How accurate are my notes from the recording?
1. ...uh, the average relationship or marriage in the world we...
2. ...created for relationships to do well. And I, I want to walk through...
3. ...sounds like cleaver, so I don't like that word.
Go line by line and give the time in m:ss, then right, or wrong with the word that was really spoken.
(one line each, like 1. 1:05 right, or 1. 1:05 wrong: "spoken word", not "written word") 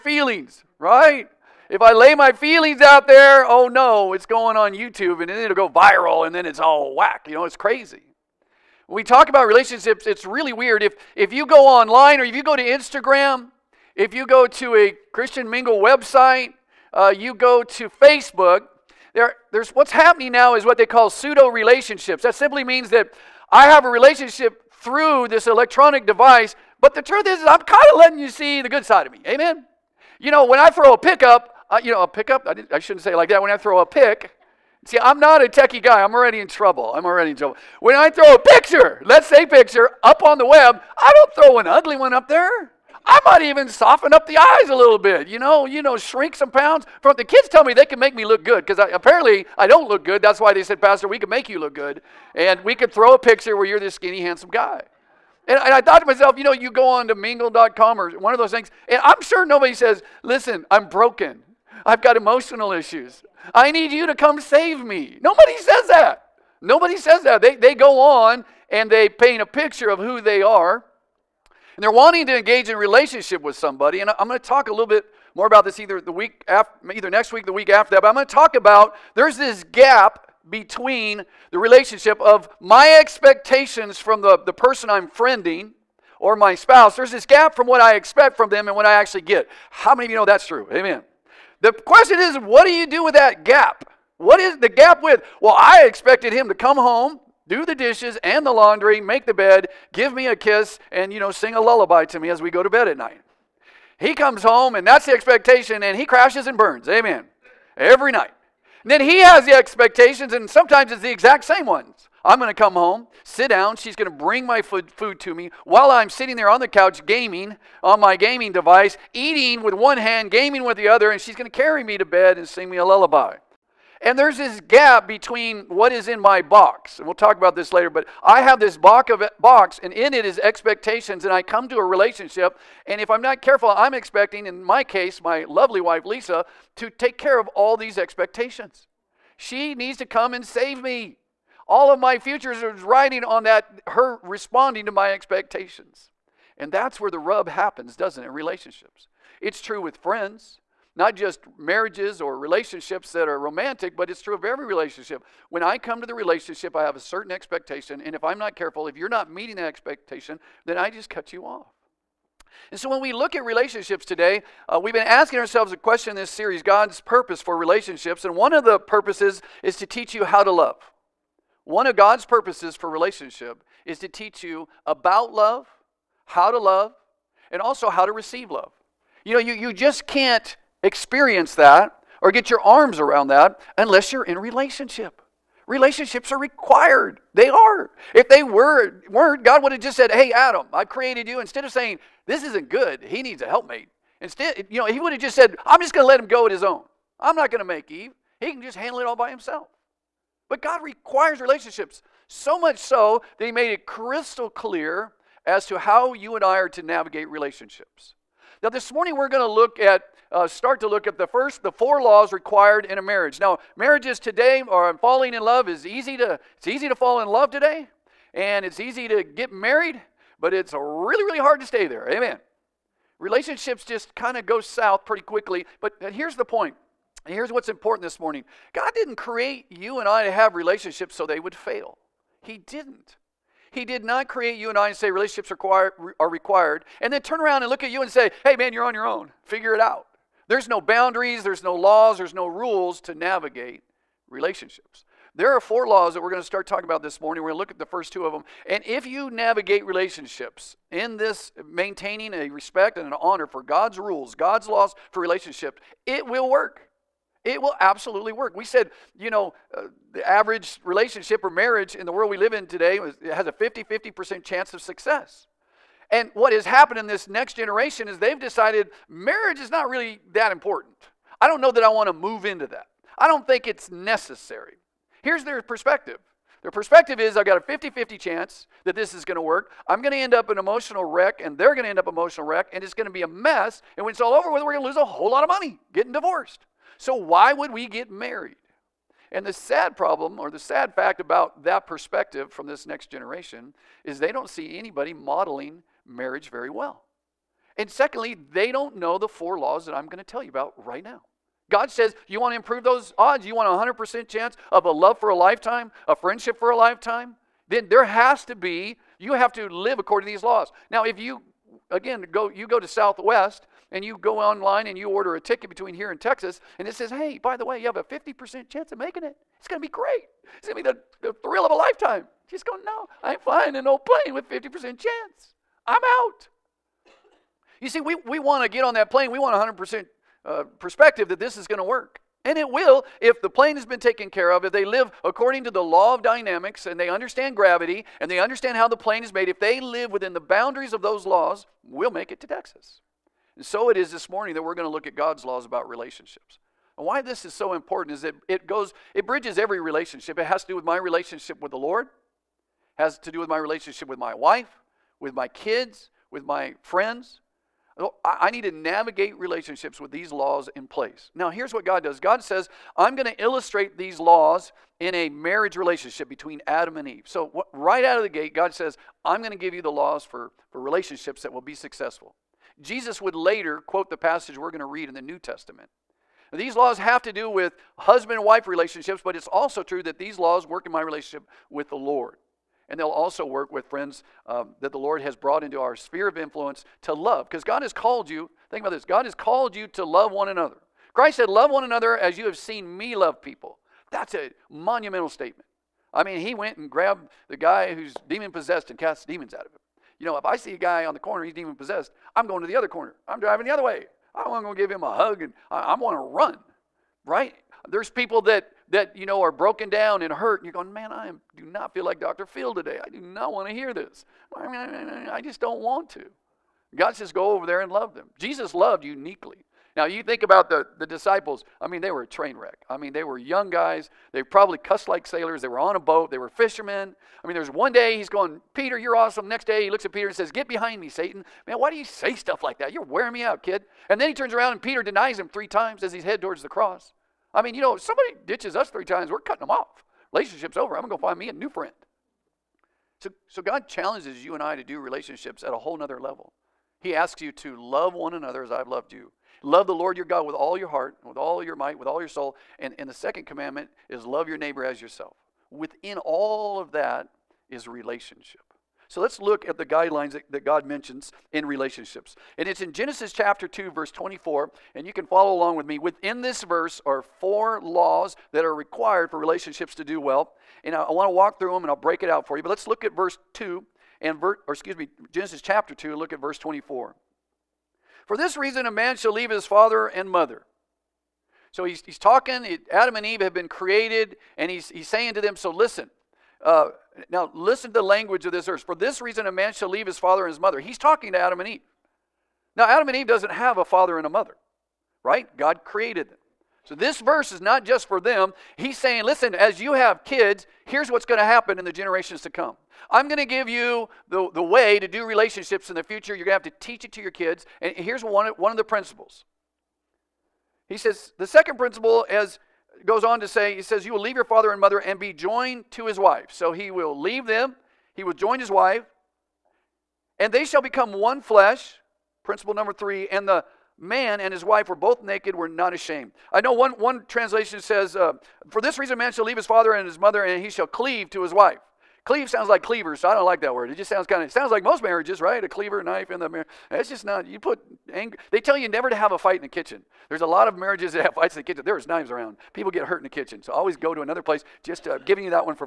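1. 4:19 right
2. 7:48 wrong: "required", not "created"
3. 8:52 right.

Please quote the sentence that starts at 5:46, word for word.
And why this is so important is that it goes, it bridges every relationship.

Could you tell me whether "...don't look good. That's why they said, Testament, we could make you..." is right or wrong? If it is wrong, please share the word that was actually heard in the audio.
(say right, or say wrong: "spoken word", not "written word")
wrong: "Pastor", not "Testament".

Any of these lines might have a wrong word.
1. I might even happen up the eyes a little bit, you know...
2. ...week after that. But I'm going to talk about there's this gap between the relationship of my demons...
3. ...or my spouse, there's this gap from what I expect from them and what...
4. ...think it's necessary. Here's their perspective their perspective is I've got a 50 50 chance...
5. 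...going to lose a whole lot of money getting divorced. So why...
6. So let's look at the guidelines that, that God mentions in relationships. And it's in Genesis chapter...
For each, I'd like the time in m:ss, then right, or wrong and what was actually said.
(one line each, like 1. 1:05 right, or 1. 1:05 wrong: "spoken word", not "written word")
1. 0:43 wrong: "soften", not "happen"
2. 1:17 wrong: "expectations", not "demons"
3. 1:26 right
4. 4:33 right
5. 4:44 right
6. 7:39 right.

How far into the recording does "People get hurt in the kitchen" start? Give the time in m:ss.
9:02.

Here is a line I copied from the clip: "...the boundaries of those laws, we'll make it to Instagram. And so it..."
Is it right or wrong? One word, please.
wrong.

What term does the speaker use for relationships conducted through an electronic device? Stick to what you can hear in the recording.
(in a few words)
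pseudo relationships.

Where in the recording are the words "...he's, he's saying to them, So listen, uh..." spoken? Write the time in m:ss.
8:04.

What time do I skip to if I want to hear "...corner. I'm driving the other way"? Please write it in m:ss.
6:42.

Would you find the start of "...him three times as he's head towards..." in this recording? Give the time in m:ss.
7:15.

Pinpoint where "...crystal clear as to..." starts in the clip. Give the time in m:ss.
3:23.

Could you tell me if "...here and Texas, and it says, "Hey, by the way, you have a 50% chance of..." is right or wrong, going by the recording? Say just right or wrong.
right.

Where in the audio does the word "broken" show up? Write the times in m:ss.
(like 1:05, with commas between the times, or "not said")
1:00, 6:49.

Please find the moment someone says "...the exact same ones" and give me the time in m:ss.
1:51.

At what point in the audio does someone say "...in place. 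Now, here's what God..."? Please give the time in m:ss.
6:00.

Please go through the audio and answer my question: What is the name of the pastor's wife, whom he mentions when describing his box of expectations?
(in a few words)
Lisa.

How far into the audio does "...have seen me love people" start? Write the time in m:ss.
6:32.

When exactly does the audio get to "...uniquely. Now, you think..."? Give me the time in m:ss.
6:59.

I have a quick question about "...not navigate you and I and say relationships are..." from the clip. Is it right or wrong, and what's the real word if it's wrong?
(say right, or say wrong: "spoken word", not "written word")
wrong: "create", not "navigate".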